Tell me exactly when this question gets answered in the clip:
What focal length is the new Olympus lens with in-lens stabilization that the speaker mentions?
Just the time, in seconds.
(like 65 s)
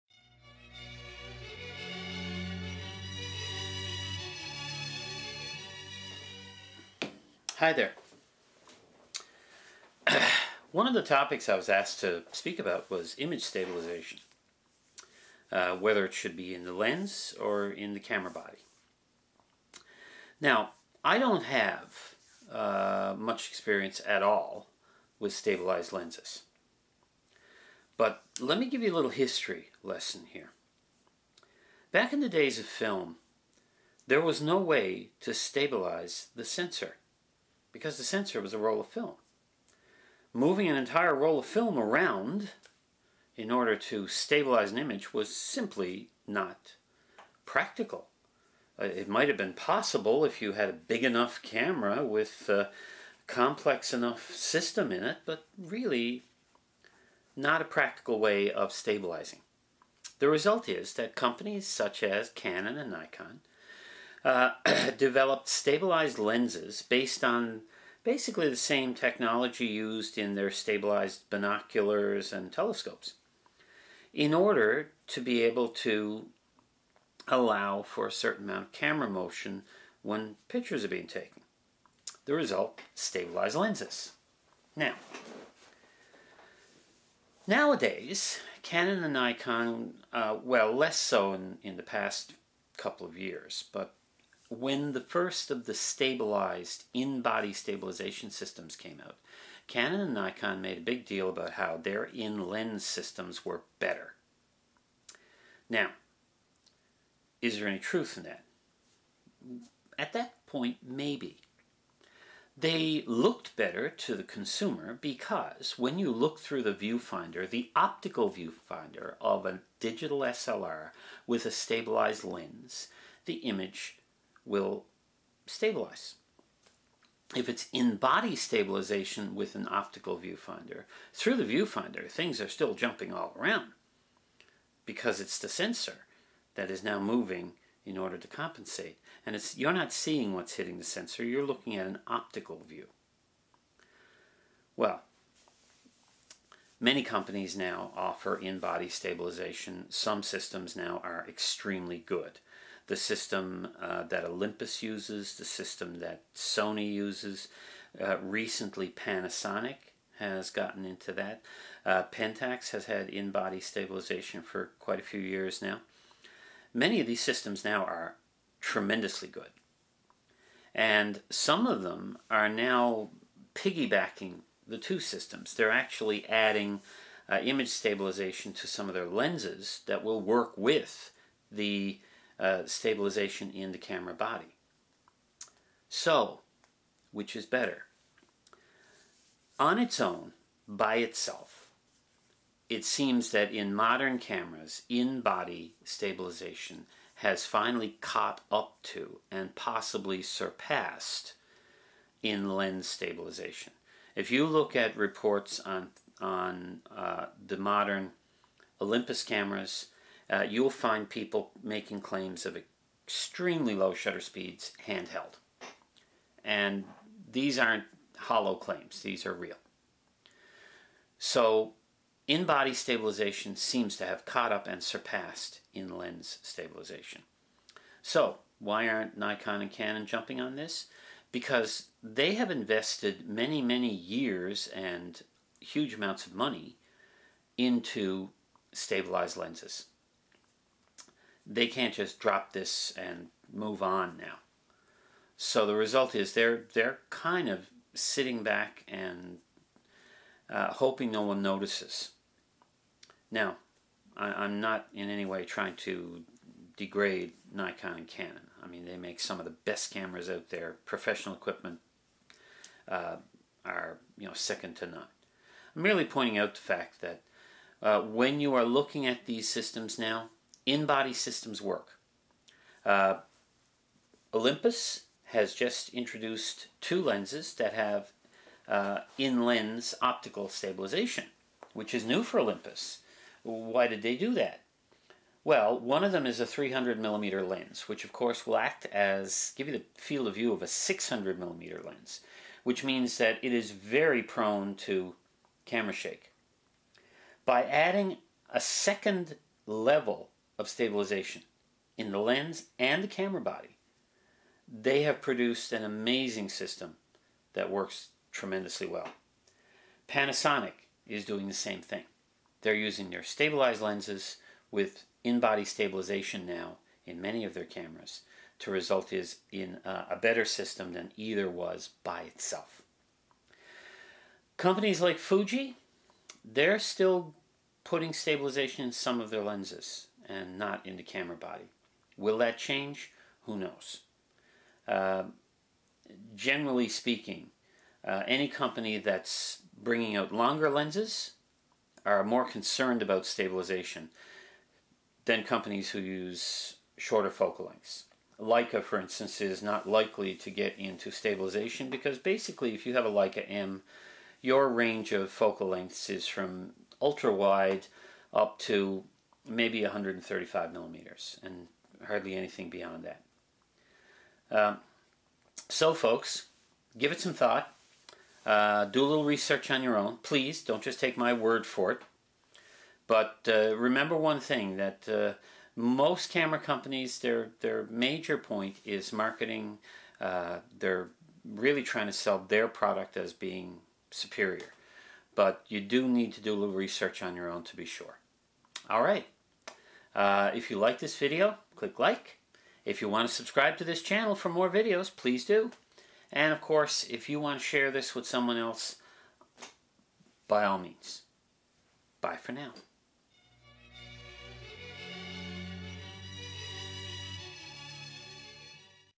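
286 s.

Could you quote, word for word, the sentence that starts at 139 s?
And it's, you're not seeing what's hitting the sensor, you're looking at an optical view.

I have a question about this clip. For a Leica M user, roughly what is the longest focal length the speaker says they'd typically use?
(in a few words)
135 millimeters.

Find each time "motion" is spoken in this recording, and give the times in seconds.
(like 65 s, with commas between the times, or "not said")
79 s.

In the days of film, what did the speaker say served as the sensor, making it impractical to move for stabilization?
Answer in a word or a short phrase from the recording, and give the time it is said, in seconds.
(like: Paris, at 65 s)
a roll of film, at 38 s.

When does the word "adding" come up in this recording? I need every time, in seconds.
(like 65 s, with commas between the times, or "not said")
176 s, 297 s.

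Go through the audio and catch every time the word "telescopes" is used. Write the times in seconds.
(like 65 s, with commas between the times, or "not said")
72 s.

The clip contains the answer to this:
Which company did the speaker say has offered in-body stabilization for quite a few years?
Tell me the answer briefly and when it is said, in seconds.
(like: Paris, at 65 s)
Pentax, at 162 s.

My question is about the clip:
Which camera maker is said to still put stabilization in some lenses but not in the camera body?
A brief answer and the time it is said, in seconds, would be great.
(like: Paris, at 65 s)
Fuji, at 325 s.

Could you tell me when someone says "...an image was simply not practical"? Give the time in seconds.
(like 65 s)
44 s.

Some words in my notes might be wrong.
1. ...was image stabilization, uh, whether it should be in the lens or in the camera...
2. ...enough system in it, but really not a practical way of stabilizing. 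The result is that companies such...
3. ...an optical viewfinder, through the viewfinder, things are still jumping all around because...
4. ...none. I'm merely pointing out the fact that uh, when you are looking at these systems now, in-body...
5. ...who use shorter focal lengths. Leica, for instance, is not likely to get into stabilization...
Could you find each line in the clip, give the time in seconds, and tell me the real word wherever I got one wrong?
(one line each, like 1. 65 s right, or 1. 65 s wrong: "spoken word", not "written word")
1. 12 s right
2. 53 s right
3. 129 s right
4. 264 s right
5. 345 s right.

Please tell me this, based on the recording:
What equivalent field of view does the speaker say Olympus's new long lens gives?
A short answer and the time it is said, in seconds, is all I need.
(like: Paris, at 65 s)
600 millimeter, at 290 s.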